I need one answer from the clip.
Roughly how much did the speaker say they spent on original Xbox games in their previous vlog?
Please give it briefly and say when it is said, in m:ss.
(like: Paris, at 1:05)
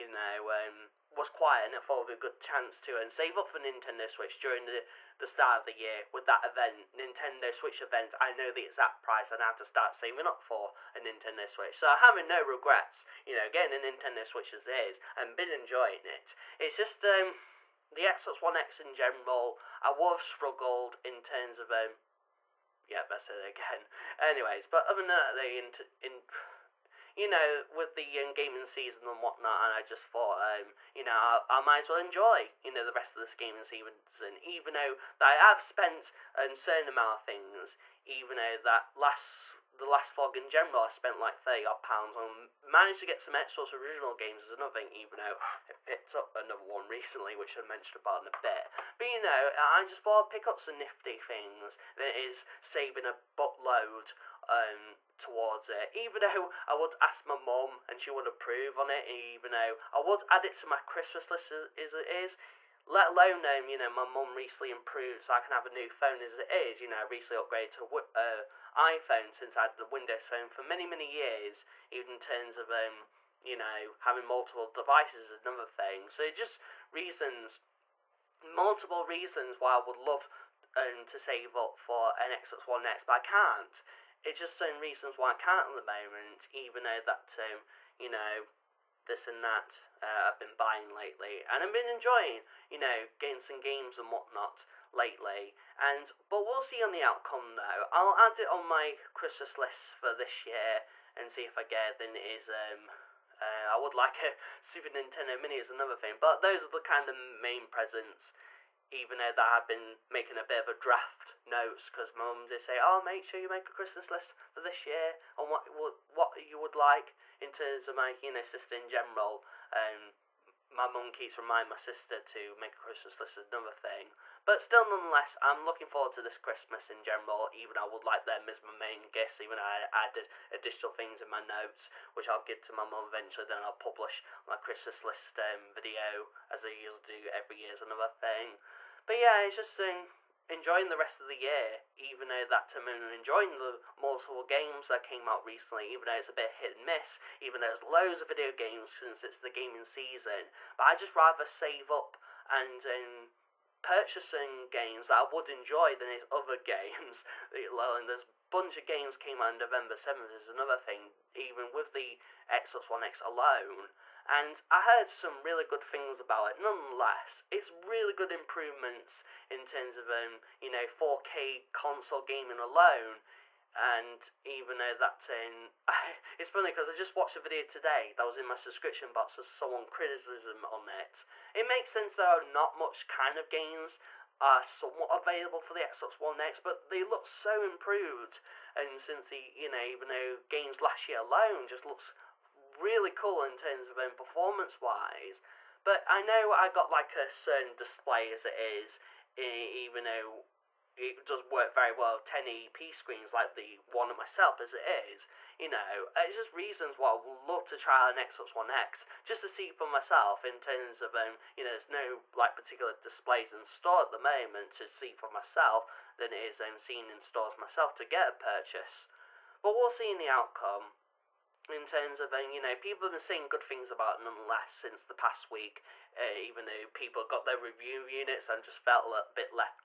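30 pounds, at 0:41.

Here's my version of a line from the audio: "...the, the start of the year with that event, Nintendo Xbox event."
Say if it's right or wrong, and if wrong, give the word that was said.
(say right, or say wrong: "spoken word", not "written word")
wrong: "Switch", not "Xbox".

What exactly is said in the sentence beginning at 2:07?
Even I would like them as my main gifts.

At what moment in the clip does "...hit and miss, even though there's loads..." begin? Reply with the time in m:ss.
2:26.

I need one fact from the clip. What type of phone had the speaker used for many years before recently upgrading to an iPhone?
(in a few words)
Windows phone.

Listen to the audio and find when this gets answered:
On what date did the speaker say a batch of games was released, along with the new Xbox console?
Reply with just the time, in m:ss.
2:39.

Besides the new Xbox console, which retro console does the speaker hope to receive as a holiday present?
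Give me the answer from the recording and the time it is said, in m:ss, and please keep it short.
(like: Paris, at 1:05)
Super Nintendo Mini, at 1:44.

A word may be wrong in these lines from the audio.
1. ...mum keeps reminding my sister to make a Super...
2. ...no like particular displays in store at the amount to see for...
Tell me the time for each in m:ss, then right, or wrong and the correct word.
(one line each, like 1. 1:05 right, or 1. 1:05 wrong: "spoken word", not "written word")
1. 2:00 wrong: "Christmas", not "Super"
2. 3:31 wrong: "moment", not "amount".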